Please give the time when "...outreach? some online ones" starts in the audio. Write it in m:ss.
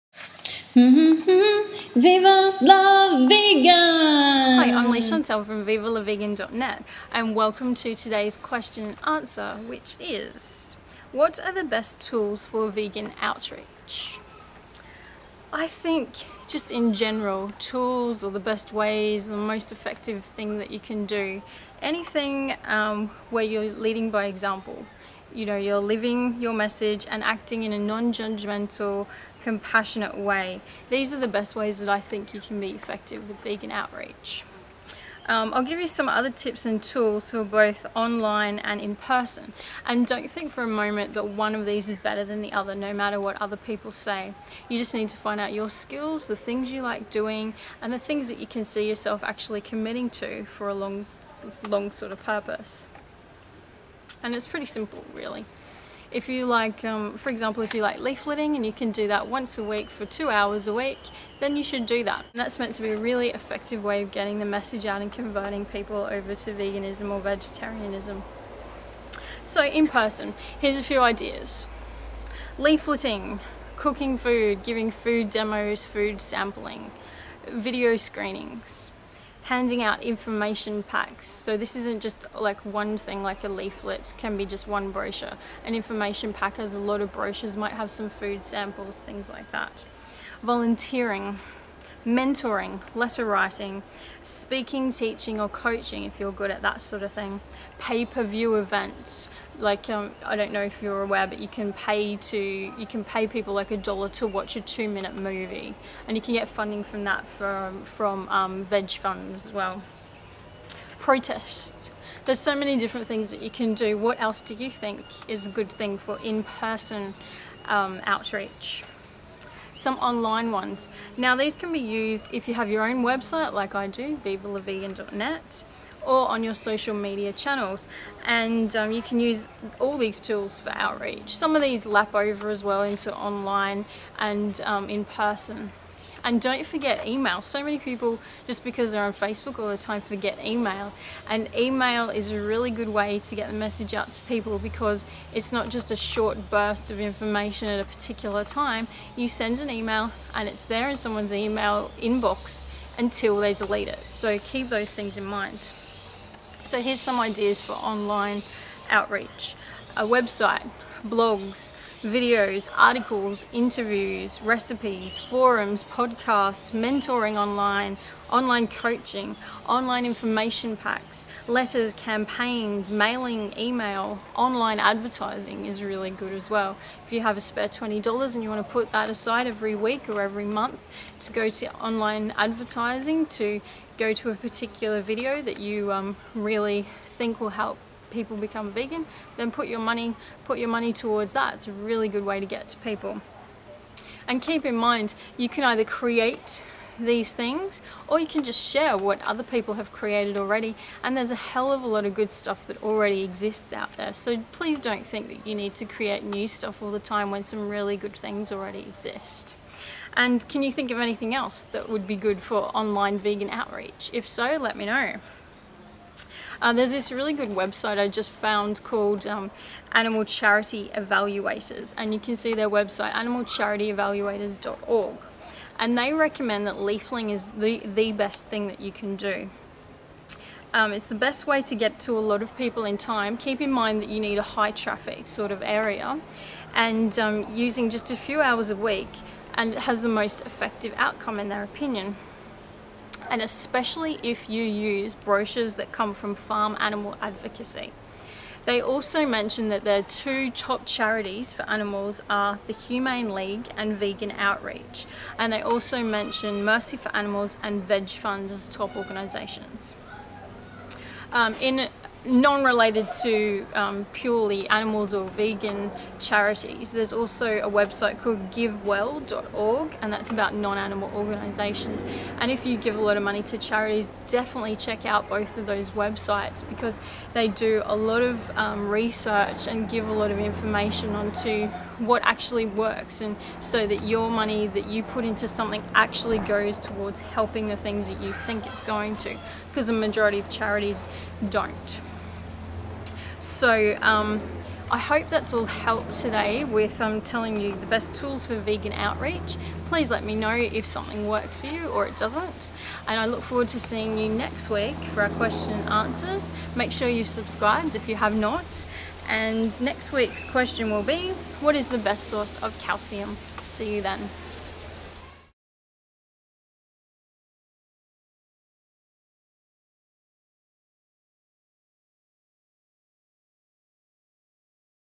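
1:58.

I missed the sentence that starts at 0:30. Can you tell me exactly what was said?
These are the best ways that I think you can be effective with vegan outreach.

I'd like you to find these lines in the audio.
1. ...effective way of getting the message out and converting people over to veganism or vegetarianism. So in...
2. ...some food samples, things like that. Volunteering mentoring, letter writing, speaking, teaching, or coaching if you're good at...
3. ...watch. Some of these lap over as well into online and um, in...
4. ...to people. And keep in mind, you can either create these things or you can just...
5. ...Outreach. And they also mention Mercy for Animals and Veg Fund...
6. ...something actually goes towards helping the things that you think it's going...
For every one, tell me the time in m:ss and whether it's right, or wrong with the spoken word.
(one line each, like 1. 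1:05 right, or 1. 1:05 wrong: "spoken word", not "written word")
1. 1:03 right
2. 1:27 right
3. 2:10 wrong: "outreach", not "watch"
4. 3:12 right
5. 4:14 right
6. 4:45 right.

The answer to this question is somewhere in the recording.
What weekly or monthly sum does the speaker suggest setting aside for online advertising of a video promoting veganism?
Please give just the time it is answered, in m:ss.
2:57.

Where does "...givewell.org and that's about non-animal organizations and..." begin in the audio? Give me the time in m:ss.
4:28.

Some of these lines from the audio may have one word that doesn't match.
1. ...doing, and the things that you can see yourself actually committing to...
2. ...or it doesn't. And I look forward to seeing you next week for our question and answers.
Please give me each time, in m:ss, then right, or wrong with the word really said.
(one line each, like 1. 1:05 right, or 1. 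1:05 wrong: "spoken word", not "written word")
1. 0:47 right
2. 5:01 right.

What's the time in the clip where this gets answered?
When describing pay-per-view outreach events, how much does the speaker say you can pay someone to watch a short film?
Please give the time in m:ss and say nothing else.
1:43.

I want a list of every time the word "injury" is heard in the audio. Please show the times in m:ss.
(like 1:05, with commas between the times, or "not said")
not said.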